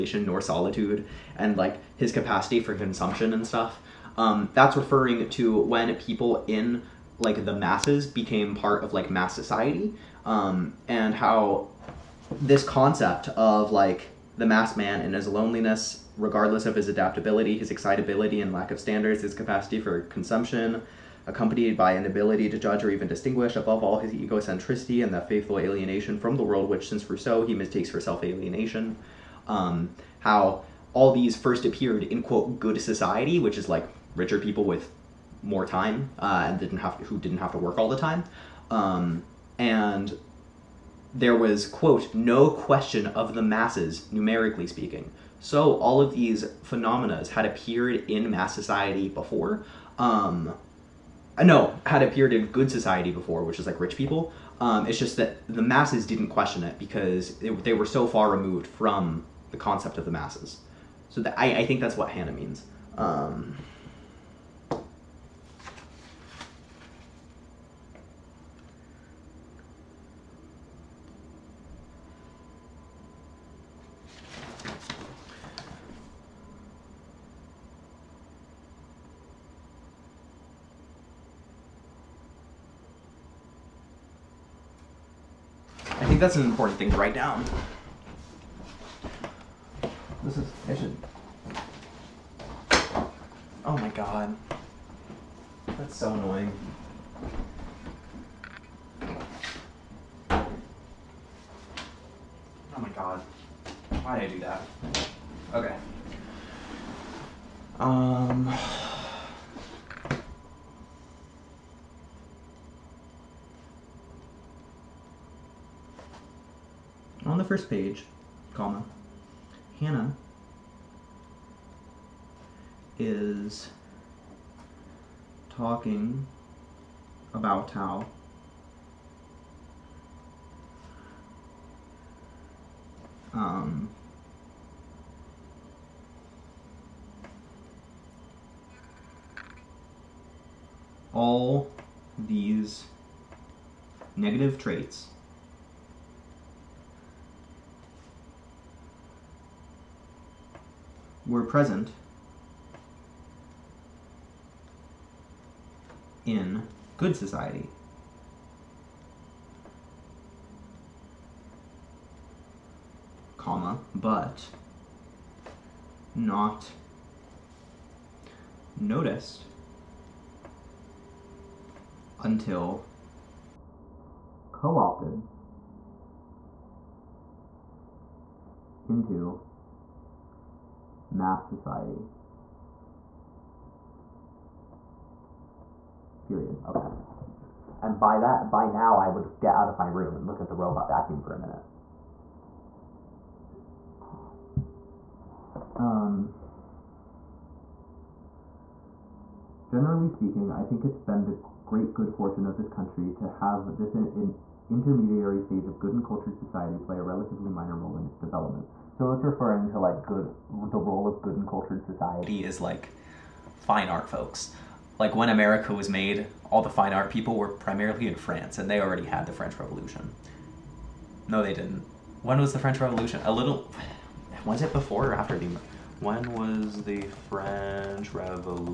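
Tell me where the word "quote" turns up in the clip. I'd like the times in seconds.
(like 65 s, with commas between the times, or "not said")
32 s, 41 s.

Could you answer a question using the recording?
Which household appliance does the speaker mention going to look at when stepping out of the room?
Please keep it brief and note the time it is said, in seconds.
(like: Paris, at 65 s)
robot vacuum, at 190 s.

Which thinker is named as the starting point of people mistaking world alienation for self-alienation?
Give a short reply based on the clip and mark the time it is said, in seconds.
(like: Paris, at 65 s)
Rousseau, at 27 s.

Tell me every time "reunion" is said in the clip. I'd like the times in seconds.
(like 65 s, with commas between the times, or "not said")
not said.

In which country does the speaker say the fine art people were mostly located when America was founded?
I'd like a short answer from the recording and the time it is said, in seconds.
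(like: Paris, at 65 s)
France, at 218 s.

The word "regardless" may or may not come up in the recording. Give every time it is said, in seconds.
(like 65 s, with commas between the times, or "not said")
16 s.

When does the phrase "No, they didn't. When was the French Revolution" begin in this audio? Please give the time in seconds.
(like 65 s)
221 s.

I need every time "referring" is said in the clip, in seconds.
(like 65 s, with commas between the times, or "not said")
4 s, 209 s.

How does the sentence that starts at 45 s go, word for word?
So all of these phenomena had appeared in mass society before.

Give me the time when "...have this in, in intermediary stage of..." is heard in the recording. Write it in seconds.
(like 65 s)
203 s.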